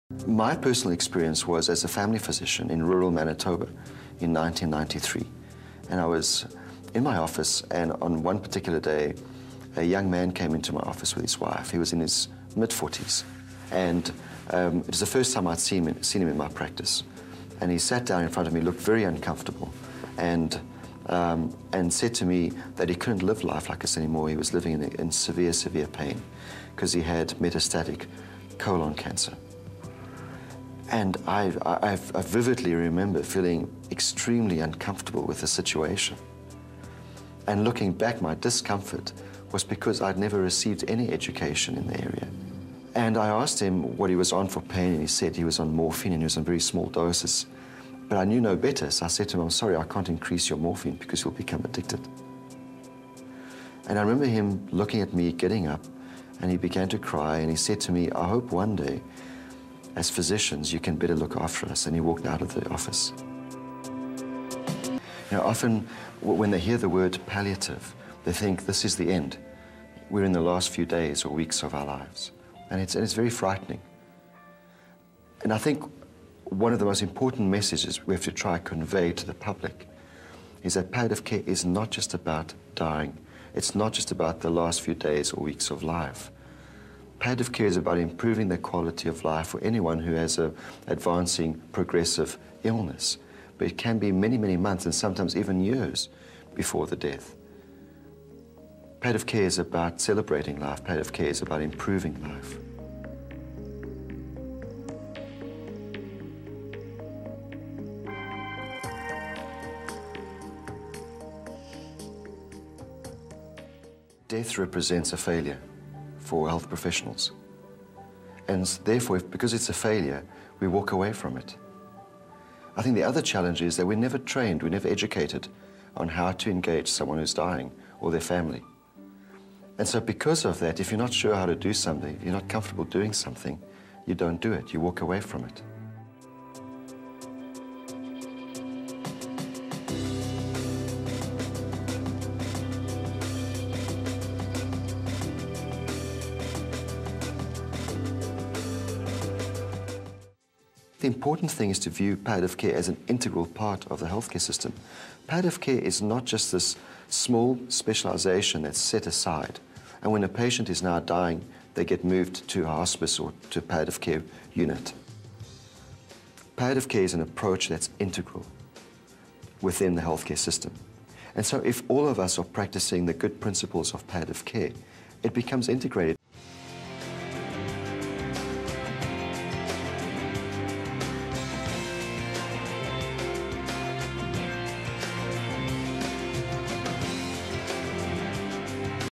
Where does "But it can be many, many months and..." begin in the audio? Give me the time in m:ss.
1:33.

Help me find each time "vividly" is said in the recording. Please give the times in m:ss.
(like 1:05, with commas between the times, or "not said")
0:32.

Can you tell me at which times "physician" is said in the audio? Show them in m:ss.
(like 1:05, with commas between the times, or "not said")
0:02, 1:00.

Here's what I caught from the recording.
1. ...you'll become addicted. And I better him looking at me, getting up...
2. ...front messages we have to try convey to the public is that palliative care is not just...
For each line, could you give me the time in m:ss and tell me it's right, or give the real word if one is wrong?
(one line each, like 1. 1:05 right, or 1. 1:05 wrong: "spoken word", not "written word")
1. 0:51 wrong: "remember", not "better"
2. 1:17 wrong: "important", not "front".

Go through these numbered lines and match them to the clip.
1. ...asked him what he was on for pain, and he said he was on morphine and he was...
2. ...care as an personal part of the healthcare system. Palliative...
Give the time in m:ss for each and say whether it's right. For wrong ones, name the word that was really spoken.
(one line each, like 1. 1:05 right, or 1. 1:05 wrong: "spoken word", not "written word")
1. 0:43 right
2. 2:32 wrong: "integral", not "personal".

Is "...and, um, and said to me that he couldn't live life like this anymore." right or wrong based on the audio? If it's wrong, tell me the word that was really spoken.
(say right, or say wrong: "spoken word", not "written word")
right.